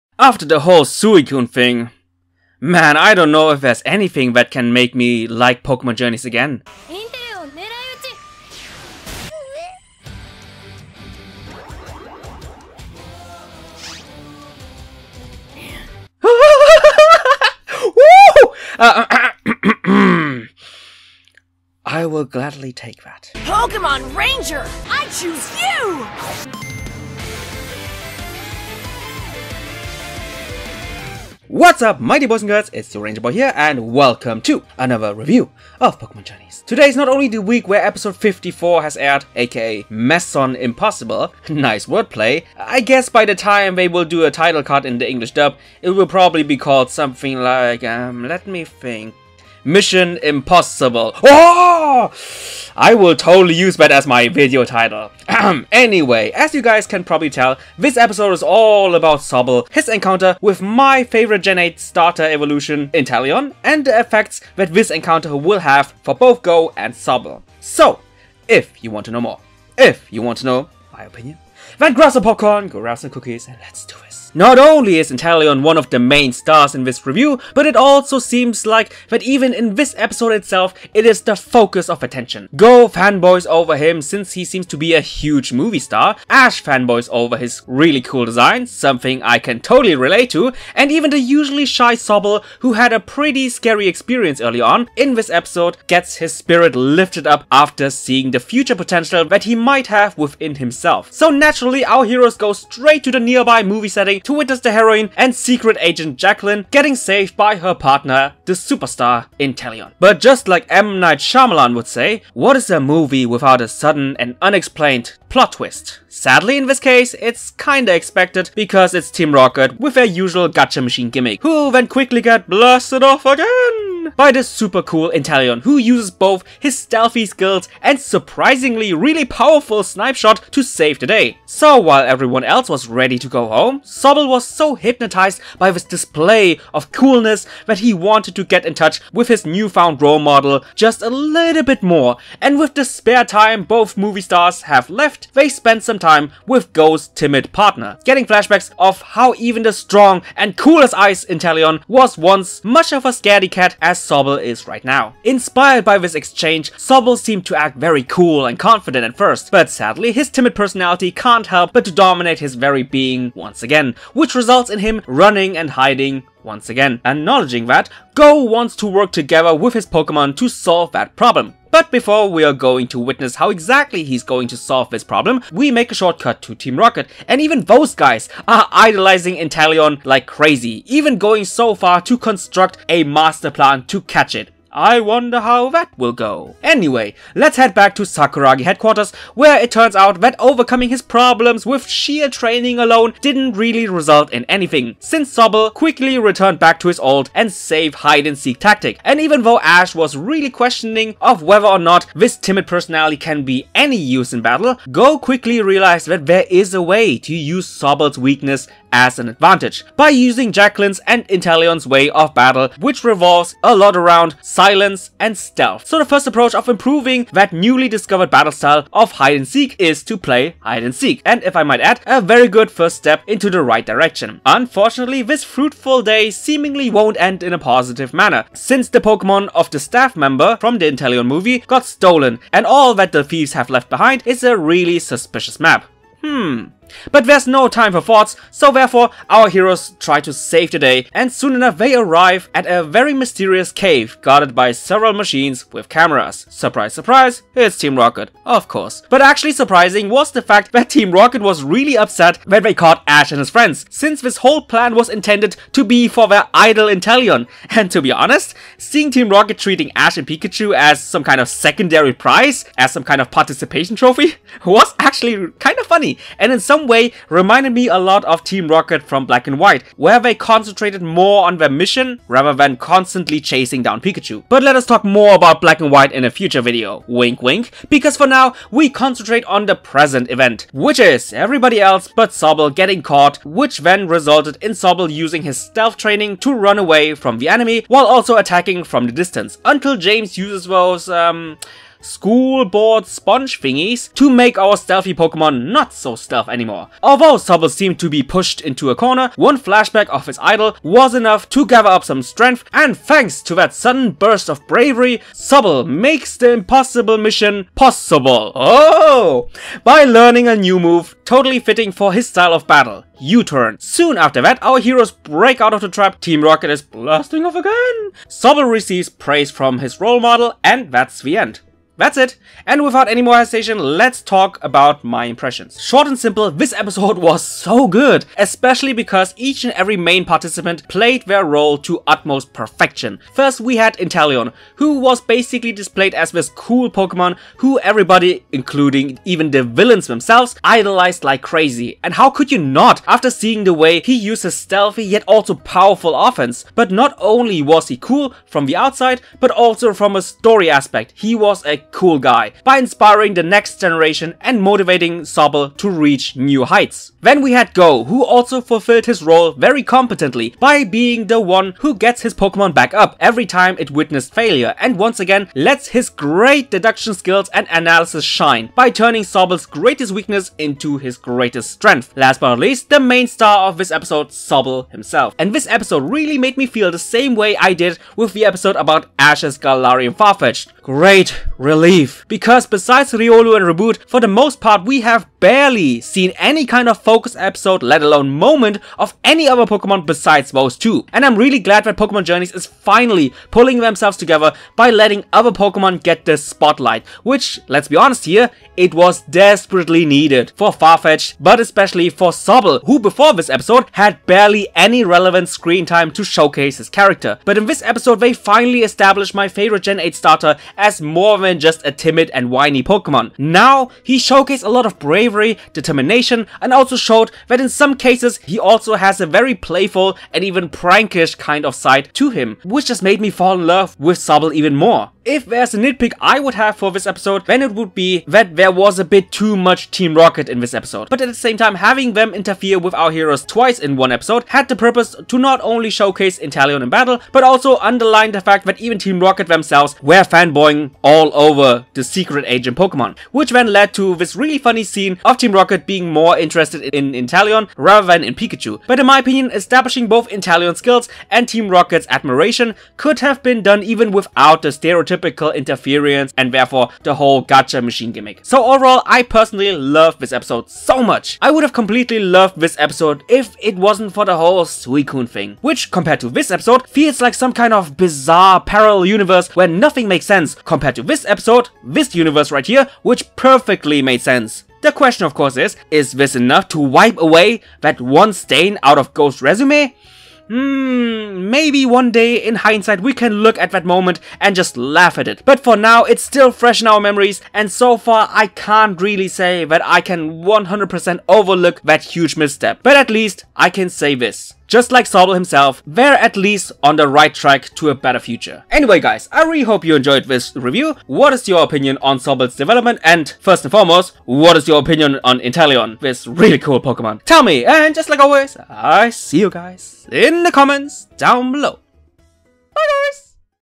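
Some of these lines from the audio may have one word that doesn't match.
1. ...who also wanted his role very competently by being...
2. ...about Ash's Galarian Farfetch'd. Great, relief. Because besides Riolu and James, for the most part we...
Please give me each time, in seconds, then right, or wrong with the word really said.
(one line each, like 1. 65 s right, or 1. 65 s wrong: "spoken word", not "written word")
1. 358 s wrong: "fulfilled", not "wanted"
2. 378 s wrong: "Raboot", not "James".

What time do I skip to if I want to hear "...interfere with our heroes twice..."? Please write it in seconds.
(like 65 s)
432 s.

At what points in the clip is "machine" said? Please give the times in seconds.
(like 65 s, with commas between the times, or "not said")
120 s, 245 s, 457 s.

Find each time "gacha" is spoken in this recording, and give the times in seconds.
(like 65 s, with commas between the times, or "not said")
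120 s, 457 s.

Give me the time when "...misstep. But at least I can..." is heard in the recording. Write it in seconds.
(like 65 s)
492 s.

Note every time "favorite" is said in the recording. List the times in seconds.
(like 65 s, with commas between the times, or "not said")
61 s, 409 s.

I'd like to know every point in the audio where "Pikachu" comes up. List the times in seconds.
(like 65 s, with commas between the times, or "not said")
260 s, 274 s, 448 s.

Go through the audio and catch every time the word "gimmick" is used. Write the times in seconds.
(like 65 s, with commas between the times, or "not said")
121 s, 458 s.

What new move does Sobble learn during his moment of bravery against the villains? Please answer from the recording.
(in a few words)
U-turn.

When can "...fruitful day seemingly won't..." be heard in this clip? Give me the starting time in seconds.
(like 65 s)
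225 s.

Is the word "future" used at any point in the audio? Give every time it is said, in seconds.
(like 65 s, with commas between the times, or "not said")
98 s, 276 s, 498 s.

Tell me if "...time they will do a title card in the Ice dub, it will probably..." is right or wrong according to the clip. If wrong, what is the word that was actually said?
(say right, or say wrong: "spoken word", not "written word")
wrong: "English", not "Ice".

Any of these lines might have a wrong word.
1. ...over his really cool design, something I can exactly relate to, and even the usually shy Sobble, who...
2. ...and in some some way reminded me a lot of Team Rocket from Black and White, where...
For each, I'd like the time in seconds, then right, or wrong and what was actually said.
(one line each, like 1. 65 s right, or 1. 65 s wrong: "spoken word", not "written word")
1. 87 s wrong: "totally", not "exactly"
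2. 266 s right.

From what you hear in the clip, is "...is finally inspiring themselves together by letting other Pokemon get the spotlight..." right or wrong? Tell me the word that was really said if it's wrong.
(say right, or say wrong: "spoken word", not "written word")
wrong: "pulling", not "inspiring".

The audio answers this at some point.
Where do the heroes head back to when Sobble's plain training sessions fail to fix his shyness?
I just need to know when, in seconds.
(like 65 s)
188 s.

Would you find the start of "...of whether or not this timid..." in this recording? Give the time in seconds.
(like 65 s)
201 s.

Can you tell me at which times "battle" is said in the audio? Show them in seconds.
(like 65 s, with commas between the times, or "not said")
204 s, 212 s, 218 s, 312 s, 436 s.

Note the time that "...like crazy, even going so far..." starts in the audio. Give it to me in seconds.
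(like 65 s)
180 s.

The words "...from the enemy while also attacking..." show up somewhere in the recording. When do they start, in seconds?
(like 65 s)
287 s.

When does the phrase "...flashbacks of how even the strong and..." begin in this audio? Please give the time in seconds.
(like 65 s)
148 s.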